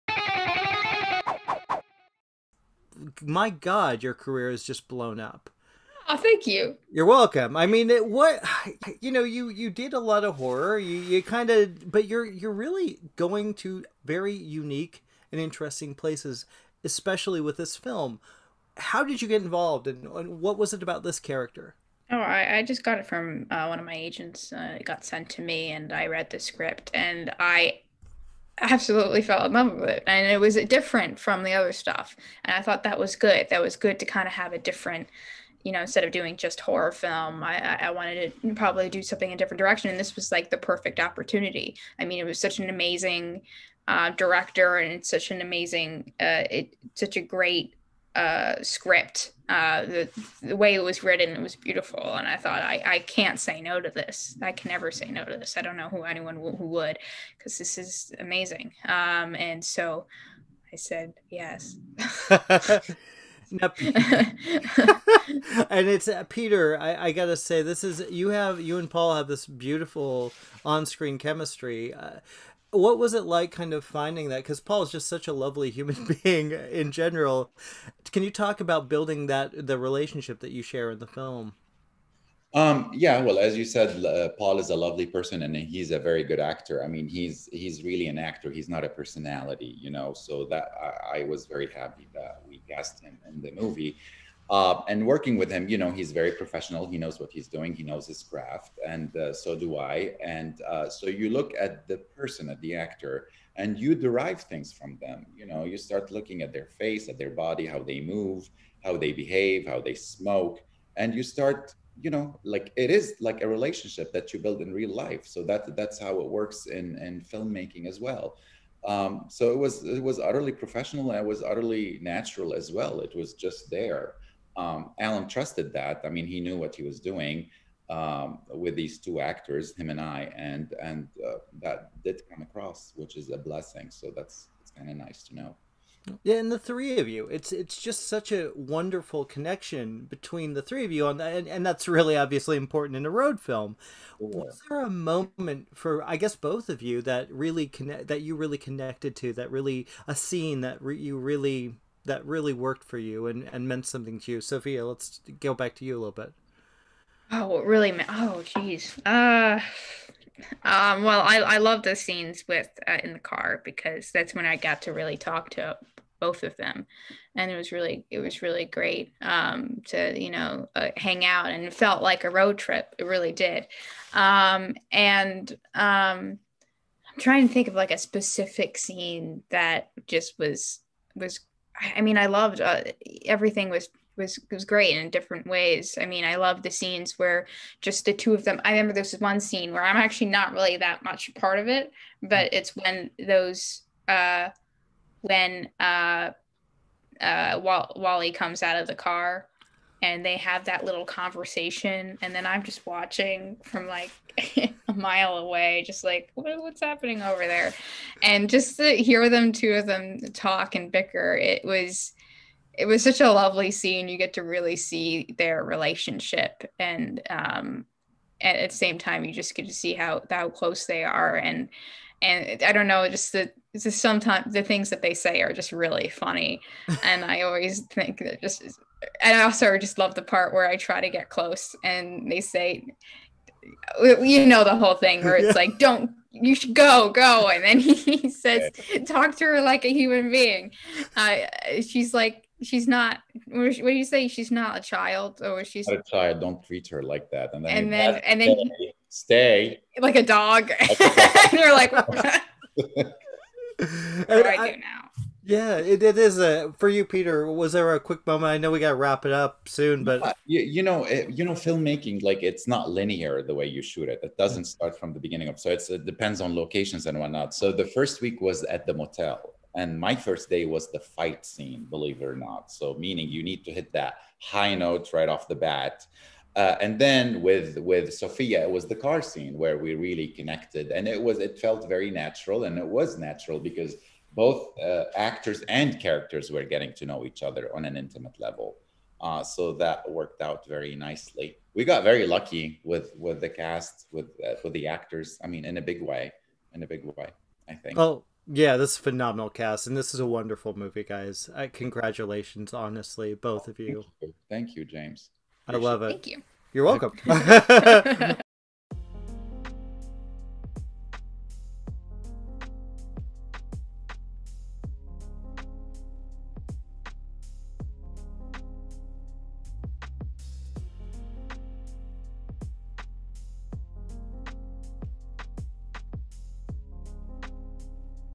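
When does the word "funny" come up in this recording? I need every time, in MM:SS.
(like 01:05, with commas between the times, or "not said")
03:46.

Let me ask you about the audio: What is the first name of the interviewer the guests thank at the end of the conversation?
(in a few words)
James.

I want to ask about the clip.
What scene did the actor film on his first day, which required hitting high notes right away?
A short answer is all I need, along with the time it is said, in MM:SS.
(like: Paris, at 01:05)
The fight scene, at 04:30.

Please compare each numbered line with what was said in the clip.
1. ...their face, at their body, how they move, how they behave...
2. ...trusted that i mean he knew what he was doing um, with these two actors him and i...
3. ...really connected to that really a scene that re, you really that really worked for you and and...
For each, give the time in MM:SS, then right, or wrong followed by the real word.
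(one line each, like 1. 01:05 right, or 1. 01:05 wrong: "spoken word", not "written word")
1. 01:46 right
2. 02:05 right
3. 02:28 right.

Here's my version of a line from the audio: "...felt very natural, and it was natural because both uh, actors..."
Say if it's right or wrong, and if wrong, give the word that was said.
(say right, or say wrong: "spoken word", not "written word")
right.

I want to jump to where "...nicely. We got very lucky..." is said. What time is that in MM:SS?
04:50.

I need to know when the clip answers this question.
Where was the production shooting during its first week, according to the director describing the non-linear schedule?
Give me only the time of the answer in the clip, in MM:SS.
04:28.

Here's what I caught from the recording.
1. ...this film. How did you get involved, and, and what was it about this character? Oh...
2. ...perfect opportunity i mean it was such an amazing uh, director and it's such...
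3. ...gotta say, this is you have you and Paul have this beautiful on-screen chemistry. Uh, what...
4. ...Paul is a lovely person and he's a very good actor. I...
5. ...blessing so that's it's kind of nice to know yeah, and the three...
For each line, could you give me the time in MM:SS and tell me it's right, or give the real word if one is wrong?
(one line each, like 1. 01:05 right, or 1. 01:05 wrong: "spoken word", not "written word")
1. 00:17 right
2. 00:40 right
3. 01:07 right
4. 01:24 right
5. 02:13 right.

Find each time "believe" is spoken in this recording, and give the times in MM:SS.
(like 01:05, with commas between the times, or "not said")
04:31.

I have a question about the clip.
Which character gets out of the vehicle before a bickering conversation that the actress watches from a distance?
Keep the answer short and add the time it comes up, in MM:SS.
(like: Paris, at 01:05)
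Wally, at 03:17.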